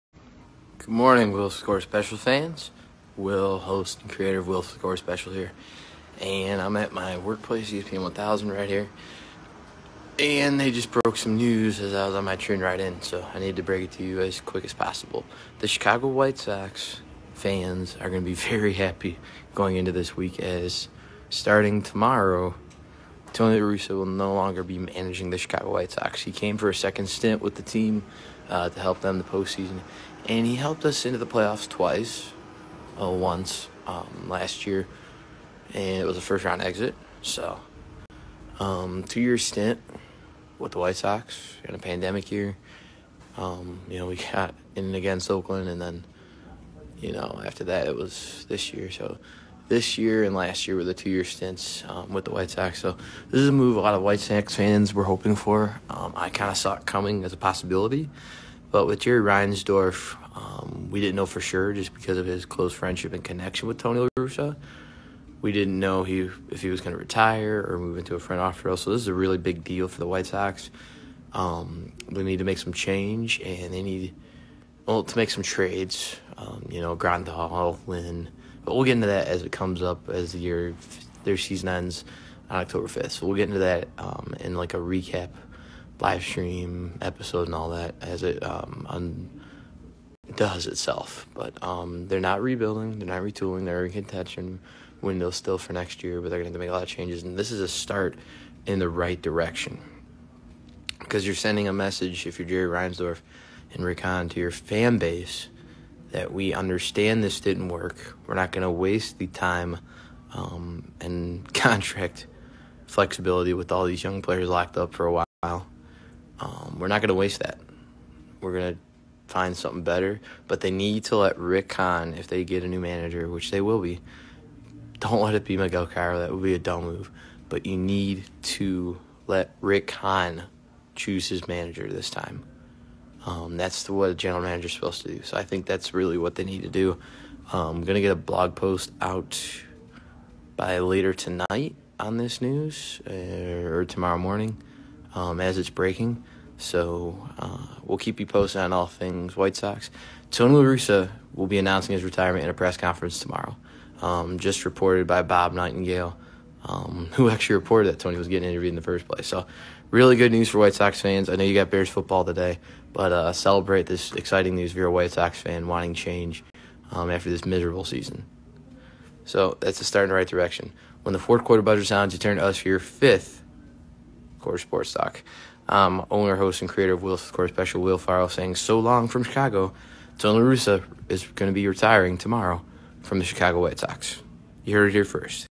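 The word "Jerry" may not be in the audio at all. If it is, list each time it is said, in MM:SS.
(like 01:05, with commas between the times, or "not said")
00:58, 01:42.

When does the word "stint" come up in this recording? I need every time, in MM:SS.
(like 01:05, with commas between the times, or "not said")
00:27, 00:39, 00:51.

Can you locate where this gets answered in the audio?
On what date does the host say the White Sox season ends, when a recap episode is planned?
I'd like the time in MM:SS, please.
01:22.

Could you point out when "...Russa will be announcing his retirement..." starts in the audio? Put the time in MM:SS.
02:30.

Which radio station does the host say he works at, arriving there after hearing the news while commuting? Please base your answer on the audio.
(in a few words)
ESPN 1000.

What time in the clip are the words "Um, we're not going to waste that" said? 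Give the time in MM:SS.
01:56.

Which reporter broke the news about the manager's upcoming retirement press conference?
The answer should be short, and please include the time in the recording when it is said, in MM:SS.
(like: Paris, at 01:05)
Bob Nightingale, at 02:35.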